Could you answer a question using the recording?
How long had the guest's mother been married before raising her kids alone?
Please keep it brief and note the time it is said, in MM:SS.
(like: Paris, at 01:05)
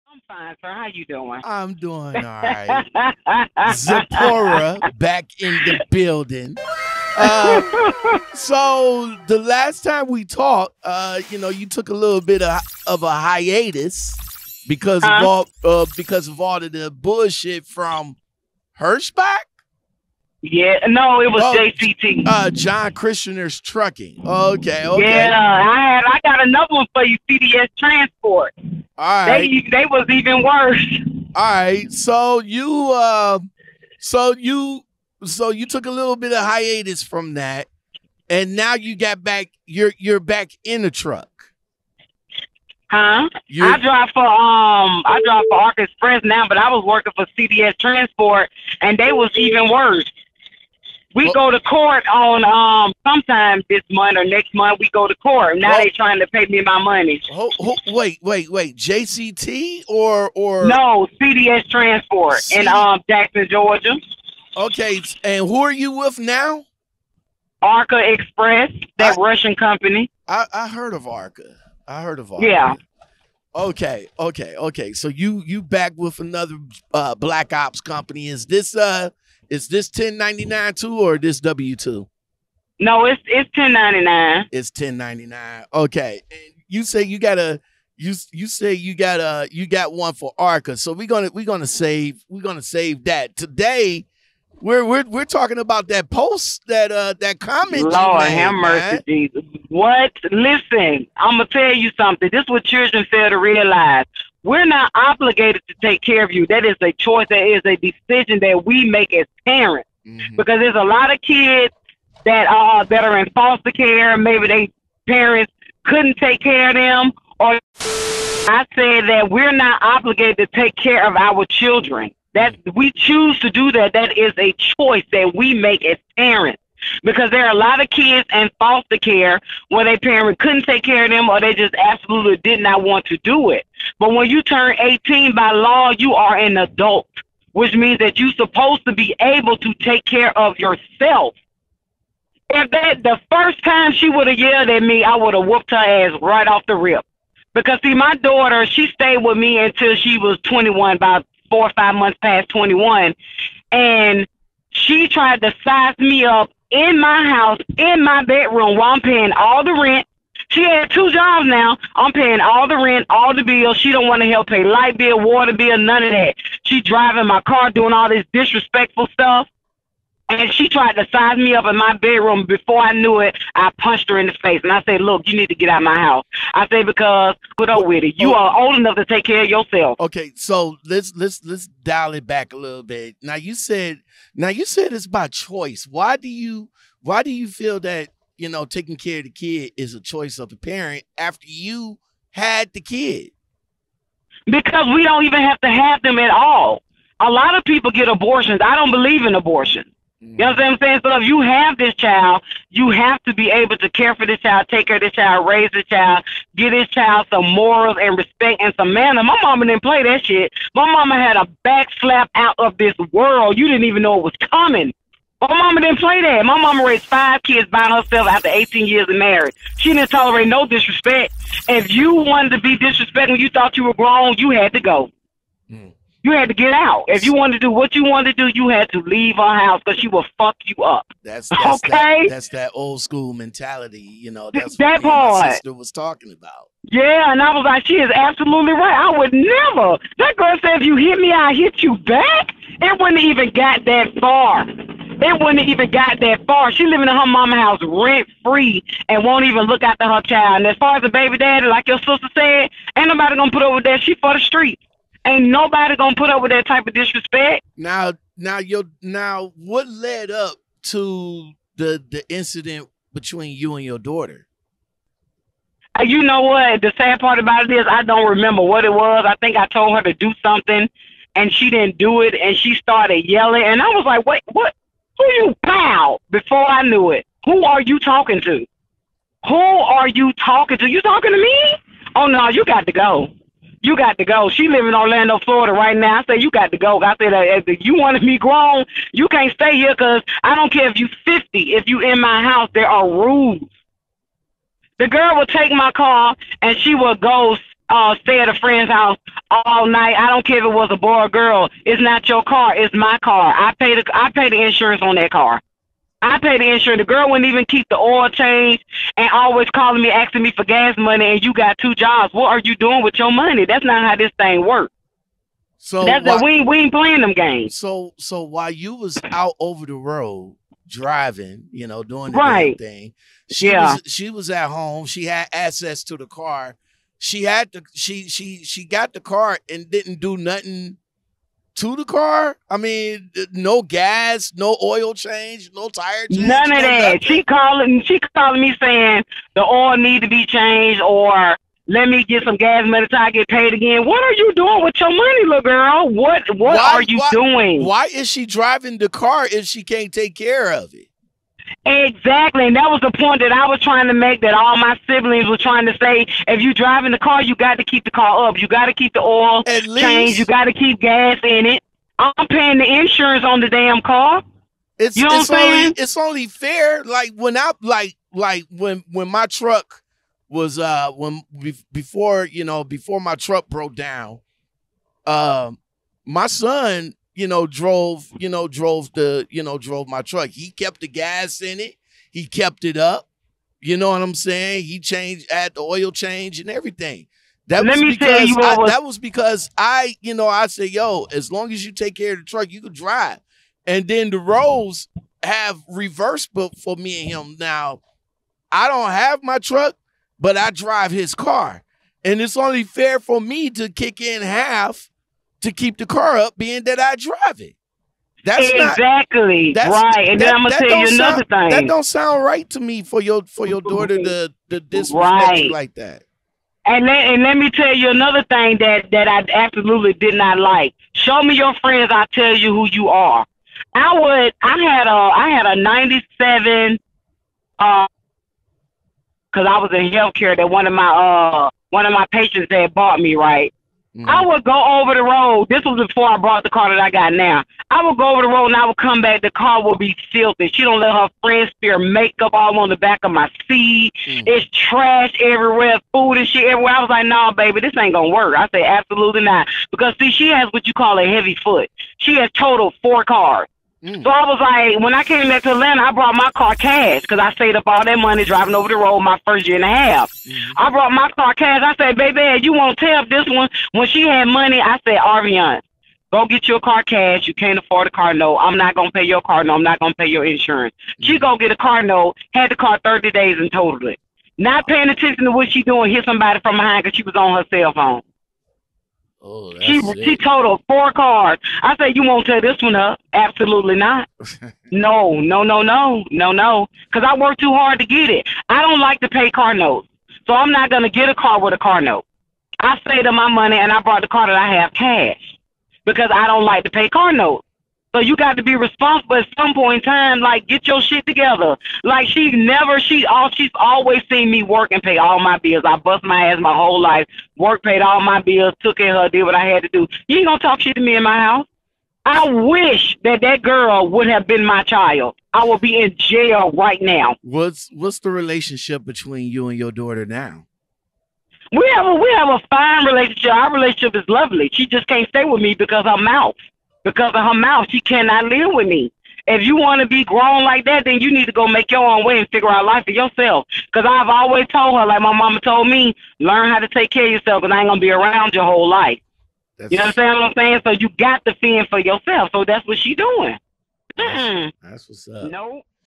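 18 years, at 03:38.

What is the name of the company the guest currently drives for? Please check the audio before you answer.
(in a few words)
Arkansas Express.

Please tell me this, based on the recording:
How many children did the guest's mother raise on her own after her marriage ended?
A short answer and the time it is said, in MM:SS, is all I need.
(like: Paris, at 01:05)
5, at 03:37.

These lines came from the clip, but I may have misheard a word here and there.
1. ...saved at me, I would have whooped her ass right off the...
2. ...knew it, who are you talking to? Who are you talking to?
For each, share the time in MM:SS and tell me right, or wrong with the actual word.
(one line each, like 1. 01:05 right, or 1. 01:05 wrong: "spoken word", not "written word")
1. 02:24 wrong: "yelled", not "saved"
2. 04:36 right.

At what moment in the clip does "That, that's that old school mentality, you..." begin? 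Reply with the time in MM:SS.
03:51.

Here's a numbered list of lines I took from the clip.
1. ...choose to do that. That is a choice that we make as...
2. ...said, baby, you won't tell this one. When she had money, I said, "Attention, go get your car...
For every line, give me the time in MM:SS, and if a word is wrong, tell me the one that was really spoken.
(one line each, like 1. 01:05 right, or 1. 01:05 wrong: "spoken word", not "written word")
1. 02:02 right
2. 07:41 wrong: "Arvion", not "Attention".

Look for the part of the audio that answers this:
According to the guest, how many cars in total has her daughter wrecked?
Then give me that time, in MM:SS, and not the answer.
07:33.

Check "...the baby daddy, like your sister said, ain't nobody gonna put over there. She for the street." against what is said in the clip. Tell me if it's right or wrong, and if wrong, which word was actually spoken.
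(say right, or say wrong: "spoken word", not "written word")
right.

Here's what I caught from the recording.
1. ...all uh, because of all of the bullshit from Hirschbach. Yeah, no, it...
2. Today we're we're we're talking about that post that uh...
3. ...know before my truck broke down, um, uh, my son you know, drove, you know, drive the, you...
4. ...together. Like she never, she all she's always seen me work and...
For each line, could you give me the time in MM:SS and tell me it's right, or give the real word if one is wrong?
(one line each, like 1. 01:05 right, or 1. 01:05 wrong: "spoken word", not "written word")
1. 00:15 right
2. 01:33 right
3. 06:12 wrong: "drove", not "drive"
4. 08:21 right.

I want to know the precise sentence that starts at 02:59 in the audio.
Okay, so let's let's let's dial it back a little bit.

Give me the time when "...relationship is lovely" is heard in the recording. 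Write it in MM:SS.
08:43.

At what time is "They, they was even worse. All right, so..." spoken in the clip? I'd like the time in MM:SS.
00:29.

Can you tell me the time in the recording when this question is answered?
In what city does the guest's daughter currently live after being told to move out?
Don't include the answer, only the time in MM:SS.
04:44.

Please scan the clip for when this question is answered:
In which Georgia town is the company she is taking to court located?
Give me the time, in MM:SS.
01:03.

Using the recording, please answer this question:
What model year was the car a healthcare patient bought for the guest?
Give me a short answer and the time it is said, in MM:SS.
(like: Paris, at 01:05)
1997, at 07:05.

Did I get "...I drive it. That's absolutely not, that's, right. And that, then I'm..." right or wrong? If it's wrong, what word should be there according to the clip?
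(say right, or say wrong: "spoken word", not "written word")
wrong: "exactly", not "absolutely".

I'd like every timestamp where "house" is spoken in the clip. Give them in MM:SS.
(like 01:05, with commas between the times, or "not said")
02:37, 02:55, 03:49, 04:07, 04:52, 04:58, 08:31.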